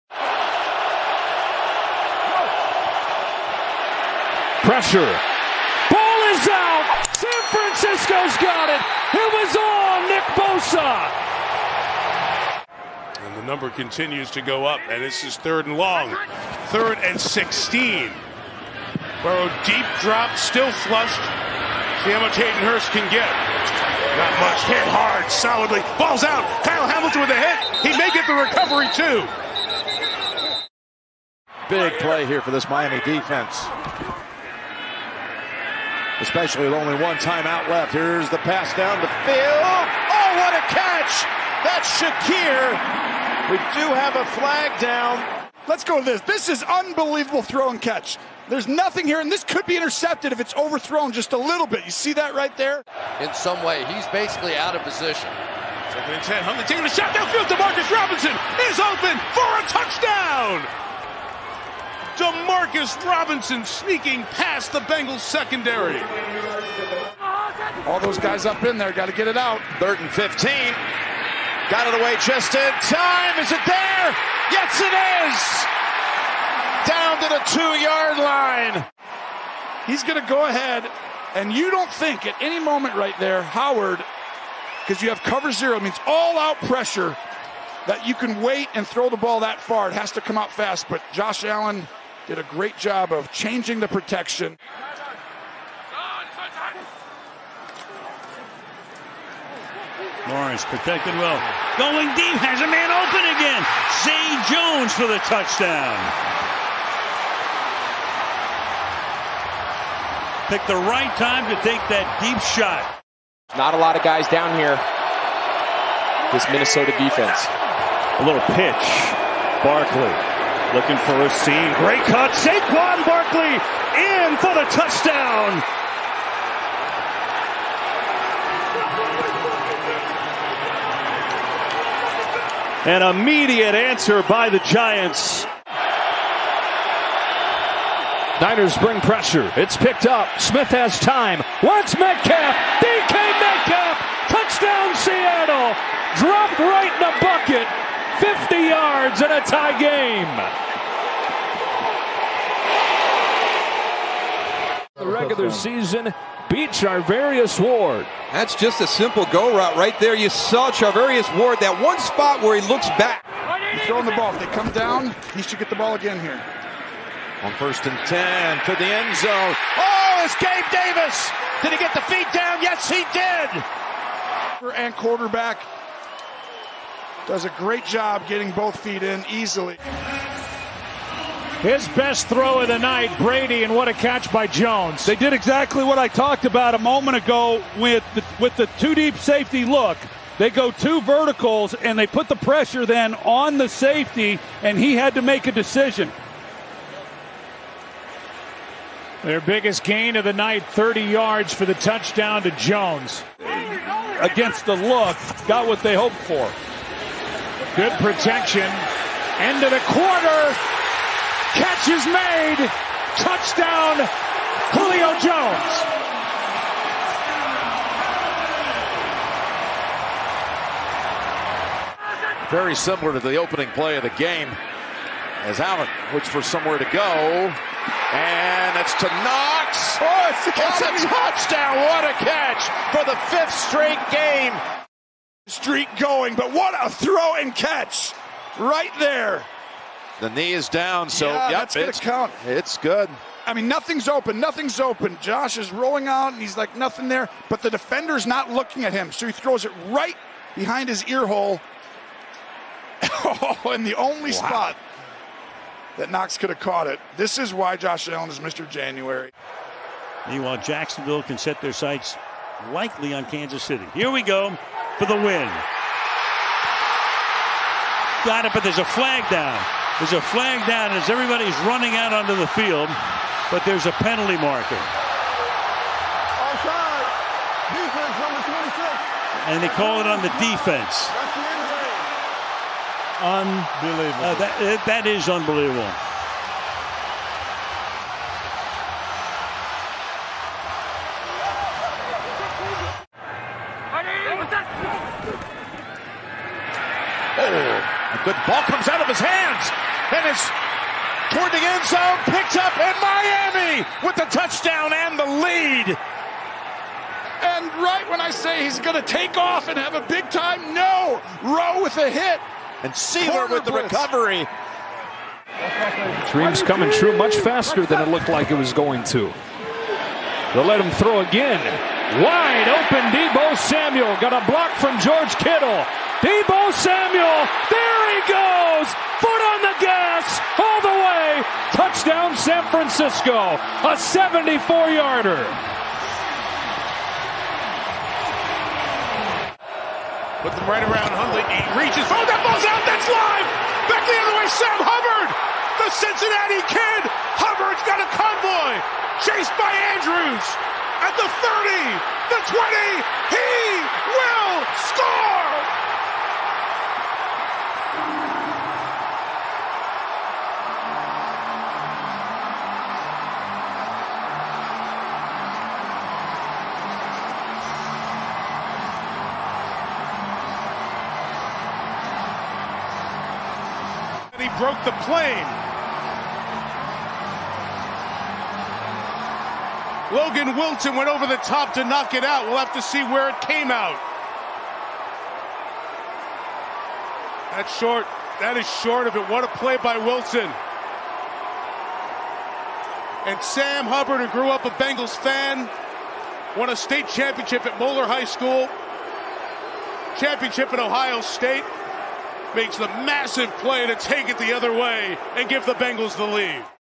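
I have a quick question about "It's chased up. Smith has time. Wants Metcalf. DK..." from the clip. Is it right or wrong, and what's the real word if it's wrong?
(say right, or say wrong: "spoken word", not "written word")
wrong: "picked", not "chased".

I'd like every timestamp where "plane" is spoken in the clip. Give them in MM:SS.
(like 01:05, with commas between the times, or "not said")
06:15.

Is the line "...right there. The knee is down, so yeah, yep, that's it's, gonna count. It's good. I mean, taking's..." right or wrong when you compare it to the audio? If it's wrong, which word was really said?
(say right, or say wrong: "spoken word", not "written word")
wrong: "nothing", not "taking".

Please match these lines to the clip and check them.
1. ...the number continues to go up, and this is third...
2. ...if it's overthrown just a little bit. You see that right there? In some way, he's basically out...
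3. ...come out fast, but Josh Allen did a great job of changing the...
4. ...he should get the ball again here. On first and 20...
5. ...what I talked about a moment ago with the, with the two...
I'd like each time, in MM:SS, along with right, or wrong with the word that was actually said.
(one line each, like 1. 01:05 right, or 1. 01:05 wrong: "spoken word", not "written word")
1. 00:13 right
2. 00:50 right
3. 01:30 right
4. 02:45 wrong: "10", not "20"
5. 03:05 right.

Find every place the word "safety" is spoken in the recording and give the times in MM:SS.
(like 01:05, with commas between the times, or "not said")
03:09, 03:13.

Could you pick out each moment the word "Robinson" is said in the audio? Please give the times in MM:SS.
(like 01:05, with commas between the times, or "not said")
00:57, 01:03.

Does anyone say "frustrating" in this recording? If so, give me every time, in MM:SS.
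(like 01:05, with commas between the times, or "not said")
not said.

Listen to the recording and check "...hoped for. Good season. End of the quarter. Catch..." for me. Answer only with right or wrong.
wrong.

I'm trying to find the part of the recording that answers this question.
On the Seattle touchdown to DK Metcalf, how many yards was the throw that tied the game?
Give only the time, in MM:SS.
02:28.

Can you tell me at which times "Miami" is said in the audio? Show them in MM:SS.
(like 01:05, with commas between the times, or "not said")
00:32, 05:02.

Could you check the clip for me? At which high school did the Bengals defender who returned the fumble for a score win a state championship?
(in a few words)
Moeller High School.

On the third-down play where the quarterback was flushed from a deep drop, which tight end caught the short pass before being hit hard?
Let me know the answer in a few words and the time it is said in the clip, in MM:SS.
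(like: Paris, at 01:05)
Hayden Hurst, at 00:22.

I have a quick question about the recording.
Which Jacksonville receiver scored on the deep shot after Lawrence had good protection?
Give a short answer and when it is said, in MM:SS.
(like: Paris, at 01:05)
Zay Jones, at 01:44.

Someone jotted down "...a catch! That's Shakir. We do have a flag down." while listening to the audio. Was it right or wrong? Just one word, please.
right.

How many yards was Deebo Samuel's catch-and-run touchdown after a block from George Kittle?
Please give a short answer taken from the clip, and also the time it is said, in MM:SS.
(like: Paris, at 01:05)
74, at 05:33.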